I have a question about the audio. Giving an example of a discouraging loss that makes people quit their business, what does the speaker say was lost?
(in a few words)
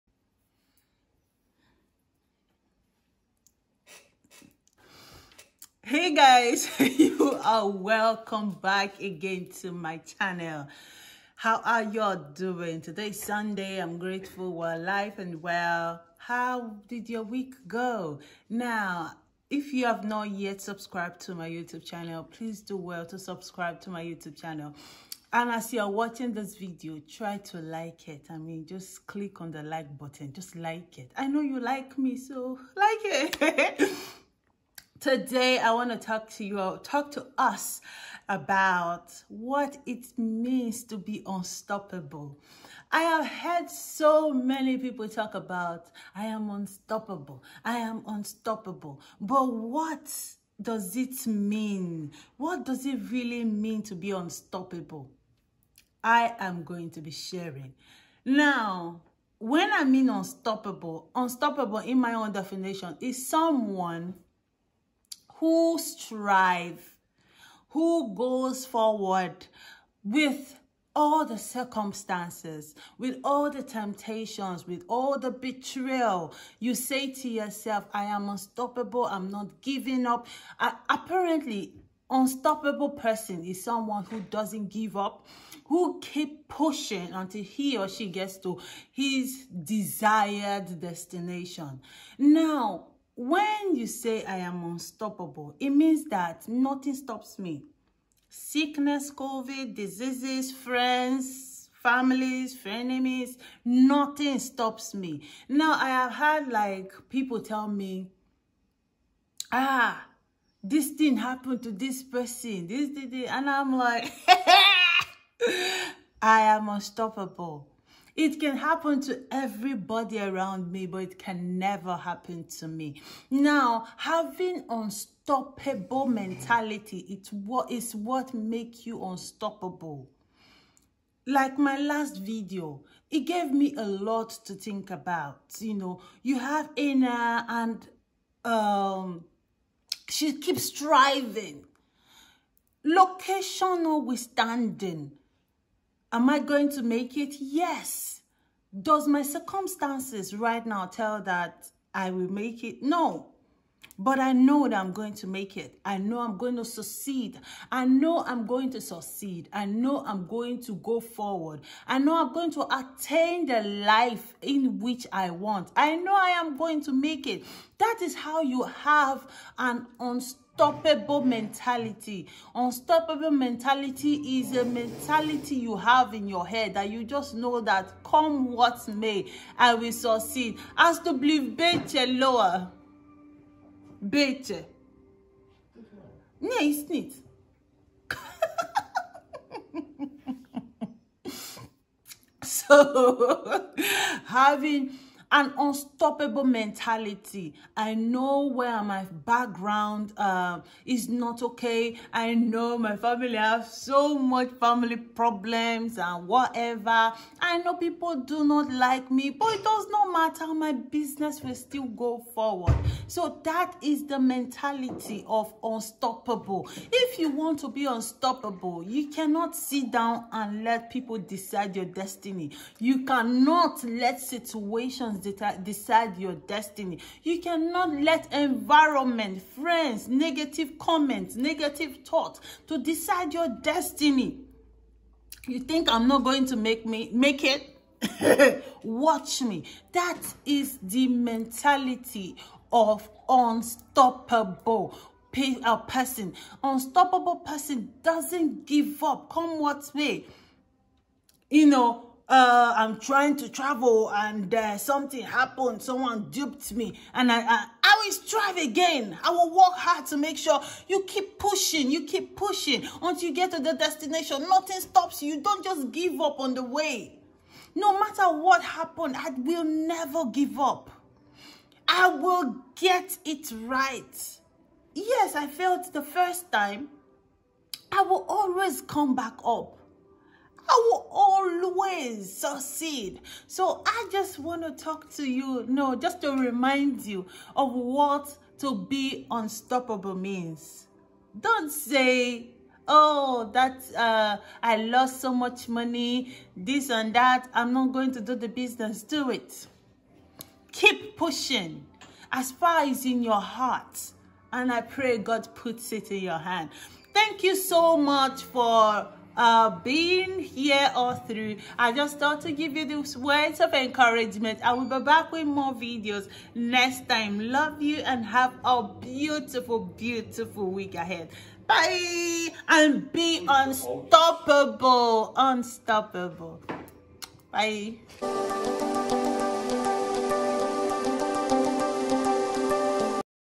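so much money.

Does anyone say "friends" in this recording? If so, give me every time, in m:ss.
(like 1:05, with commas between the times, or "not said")
1:40, 3:49.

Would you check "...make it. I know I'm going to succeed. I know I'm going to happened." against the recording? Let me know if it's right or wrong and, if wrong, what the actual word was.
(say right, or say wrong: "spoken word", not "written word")
wrong: "succeed", not "happened".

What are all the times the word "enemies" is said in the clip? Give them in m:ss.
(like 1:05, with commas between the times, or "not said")
1:42.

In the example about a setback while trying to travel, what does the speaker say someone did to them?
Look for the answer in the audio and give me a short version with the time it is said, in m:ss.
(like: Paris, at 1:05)
duped me, at 4:16.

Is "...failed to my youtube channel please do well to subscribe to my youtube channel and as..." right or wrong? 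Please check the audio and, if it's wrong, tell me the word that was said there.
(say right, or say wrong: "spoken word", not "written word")
wrong: "subscribed", not "failed".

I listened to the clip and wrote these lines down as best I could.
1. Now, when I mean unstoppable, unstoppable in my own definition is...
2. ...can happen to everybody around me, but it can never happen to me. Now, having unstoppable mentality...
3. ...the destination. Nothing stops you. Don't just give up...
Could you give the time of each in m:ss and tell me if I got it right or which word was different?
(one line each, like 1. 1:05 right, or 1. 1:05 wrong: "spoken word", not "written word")
1. 0:58 right
2. 1:58 right
3. 4:23 right.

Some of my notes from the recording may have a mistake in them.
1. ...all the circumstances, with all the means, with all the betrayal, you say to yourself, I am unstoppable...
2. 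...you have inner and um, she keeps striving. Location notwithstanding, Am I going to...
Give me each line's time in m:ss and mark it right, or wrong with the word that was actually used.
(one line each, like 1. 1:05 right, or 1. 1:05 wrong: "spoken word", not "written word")
1. 1:10 wrong: "temptations", not "means"
2. 2:16 right.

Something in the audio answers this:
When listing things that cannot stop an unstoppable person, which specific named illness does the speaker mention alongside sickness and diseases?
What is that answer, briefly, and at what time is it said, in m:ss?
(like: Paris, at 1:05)
COVID, at 1:39.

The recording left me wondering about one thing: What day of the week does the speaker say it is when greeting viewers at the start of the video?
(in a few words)
Sunday.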